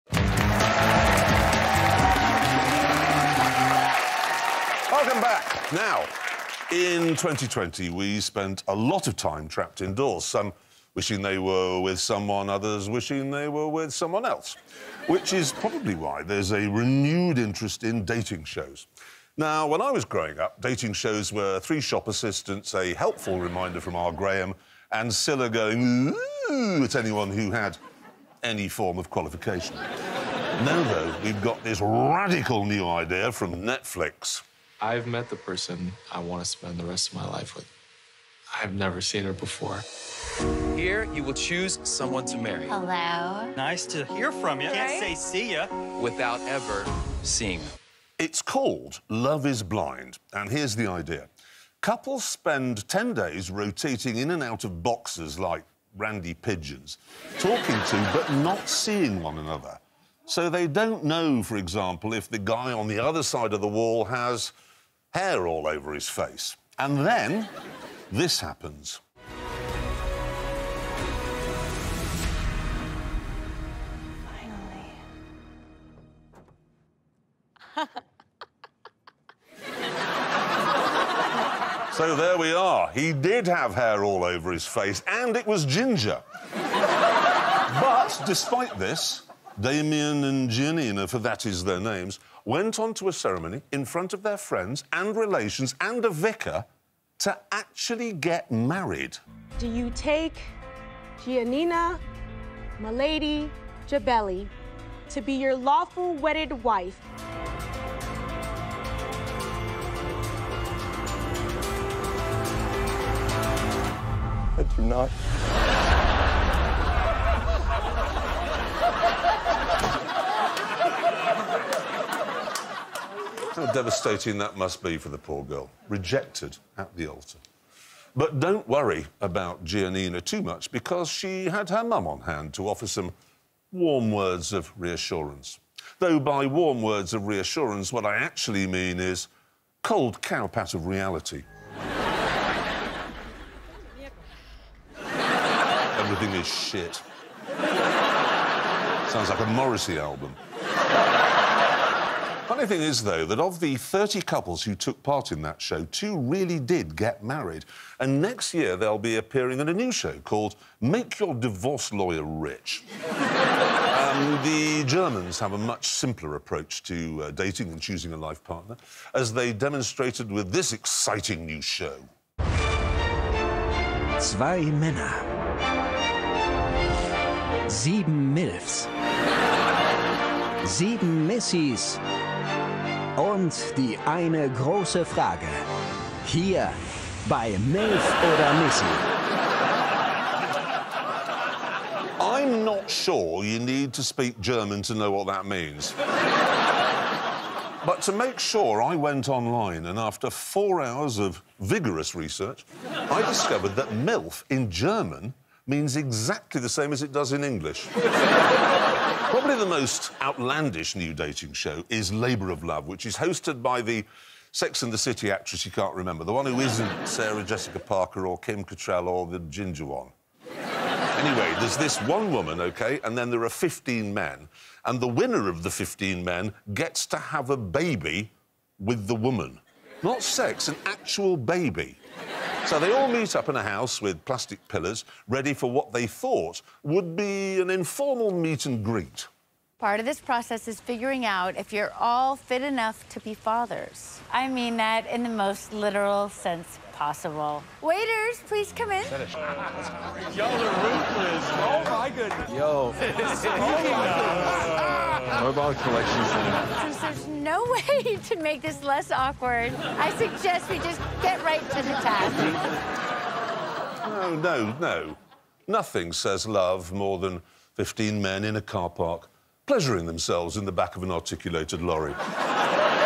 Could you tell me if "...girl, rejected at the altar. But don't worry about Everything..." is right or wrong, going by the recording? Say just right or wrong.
wrong.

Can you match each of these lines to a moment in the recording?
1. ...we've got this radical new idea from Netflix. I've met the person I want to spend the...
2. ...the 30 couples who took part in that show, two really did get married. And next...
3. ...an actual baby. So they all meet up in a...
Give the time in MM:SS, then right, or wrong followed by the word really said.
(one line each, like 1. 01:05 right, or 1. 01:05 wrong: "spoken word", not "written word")
1. 00:31 right
2. 02:33 right
3. 03:50 right.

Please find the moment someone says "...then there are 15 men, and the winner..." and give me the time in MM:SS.
03:43.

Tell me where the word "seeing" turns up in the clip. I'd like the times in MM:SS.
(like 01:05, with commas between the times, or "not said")
00:47, 00:58.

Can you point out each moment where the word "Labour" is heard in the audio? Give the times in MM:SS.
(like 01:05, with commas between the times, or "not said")
03:32.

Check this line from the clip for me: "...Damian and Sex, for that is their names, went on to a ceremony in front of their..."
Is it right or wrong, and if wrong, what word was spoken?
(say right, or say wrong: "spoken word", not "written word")
wrong: "Giannina", not "Sex".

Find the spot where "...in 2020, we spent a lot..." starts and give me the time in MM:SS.
00:06.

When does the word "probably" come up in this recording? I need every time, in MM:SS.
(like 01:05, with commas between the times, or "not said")
00:15, 03:29.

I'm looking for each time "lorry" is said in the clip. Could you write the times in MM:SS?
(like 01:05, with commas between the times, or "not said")
04:31.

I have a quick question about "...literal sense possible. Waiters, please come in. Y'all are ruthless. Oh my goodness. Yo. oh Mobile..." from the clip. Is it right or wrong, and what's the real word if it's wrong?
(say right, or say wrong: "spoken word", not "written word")
right.